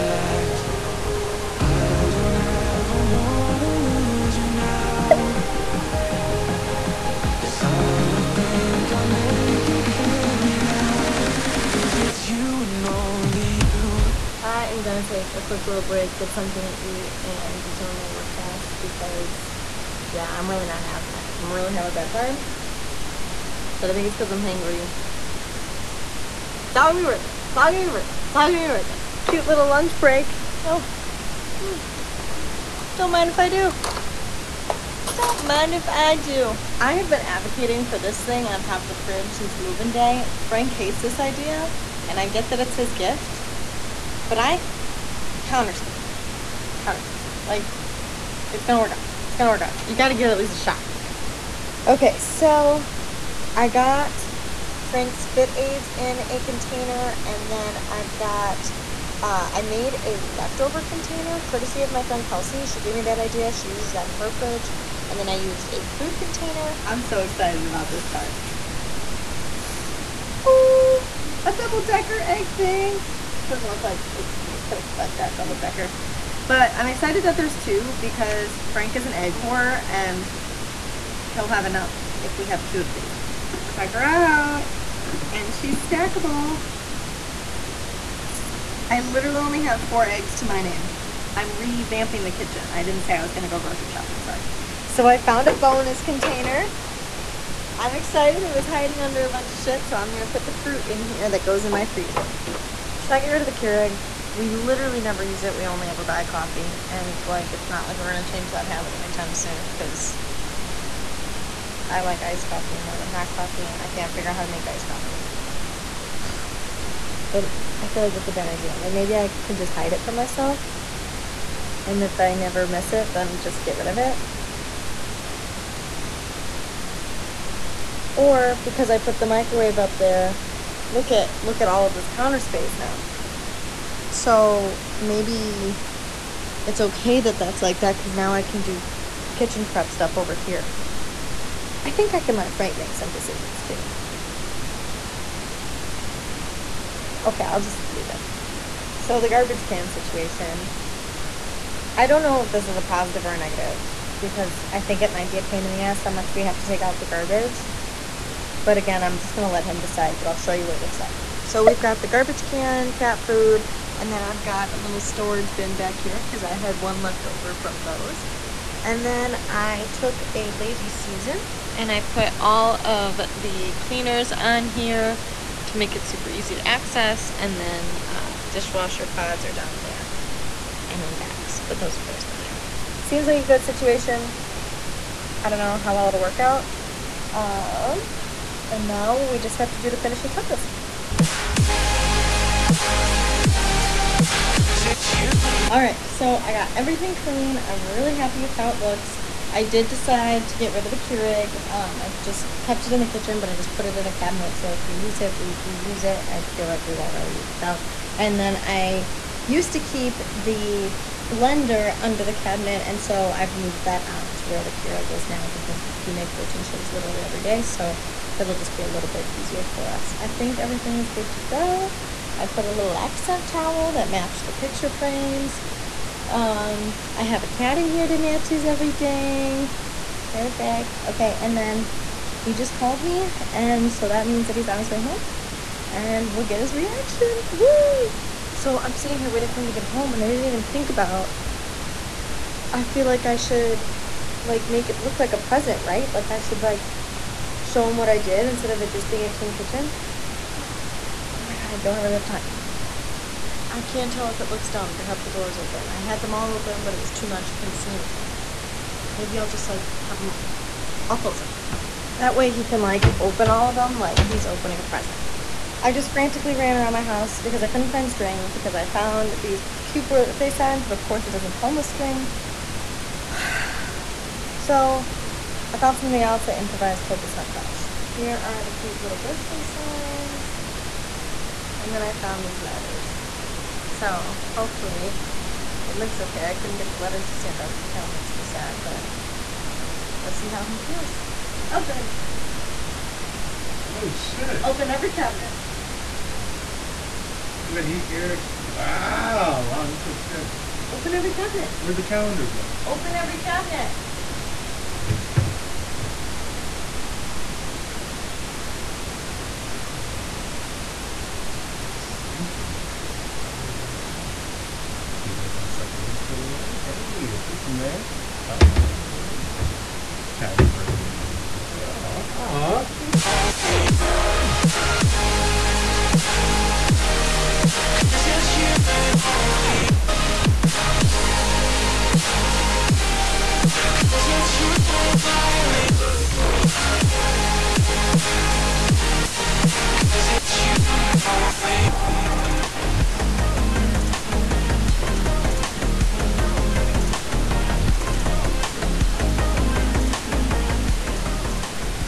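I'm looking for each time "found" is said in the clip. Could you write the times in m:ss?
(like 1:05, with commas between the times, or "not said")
1:35, 4:28, 4:35, 4:42.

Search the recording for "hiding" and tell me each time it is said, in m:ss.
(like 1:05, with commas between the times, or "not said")
1:38.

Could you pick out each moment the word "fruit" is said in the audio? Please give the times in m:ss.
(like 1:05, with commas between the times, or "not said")
1:05, 1:40.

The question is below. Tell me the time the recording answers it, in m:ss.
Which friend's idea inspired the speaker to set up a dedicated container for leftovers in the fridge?
1:02.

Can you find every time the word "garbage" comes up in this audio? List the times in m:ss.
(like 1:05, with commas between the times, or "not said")
2:29, 2:37, 2:42.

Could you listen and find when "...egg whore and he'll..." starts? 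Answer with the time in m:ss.
1:19.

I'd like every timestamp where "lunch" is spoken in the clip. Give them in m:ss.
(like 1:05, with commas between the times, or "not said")
0:29.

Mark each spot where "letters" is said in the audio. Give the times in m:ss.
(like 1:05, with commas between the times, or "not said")
4:42, 4:46.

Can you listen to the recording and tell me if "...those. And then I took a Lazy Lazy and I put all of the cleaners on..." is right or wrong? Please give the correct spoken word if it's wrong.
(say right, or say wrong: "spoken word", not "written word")
wrong: "Susan", not "Lazy".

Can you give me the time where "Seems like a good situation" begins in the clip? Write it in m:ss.
3:03.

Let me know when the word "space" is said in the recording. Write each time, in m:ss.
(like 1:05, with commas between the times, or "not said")
0:46, 2:12.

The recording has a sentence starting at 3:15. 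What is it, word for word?
Alright, so I got everything clean.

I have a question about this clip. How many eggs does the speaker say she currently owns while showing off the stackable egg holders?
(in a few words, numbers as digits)
4.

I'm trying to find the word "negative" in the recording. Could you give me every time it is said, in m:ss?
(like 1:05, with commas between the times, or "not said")
2:33.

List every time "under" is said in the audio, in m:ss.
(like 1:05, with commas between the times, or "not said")
1:39, 3:31.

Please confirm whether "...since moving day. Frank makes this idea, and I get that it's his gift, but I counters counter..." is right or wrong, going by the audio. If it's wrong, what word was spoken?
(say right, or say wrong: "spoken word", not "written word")
wrong: "hates", not "makes".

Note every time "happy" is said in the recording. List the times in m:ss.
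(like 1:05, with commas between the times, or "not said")
3:18, 5:20.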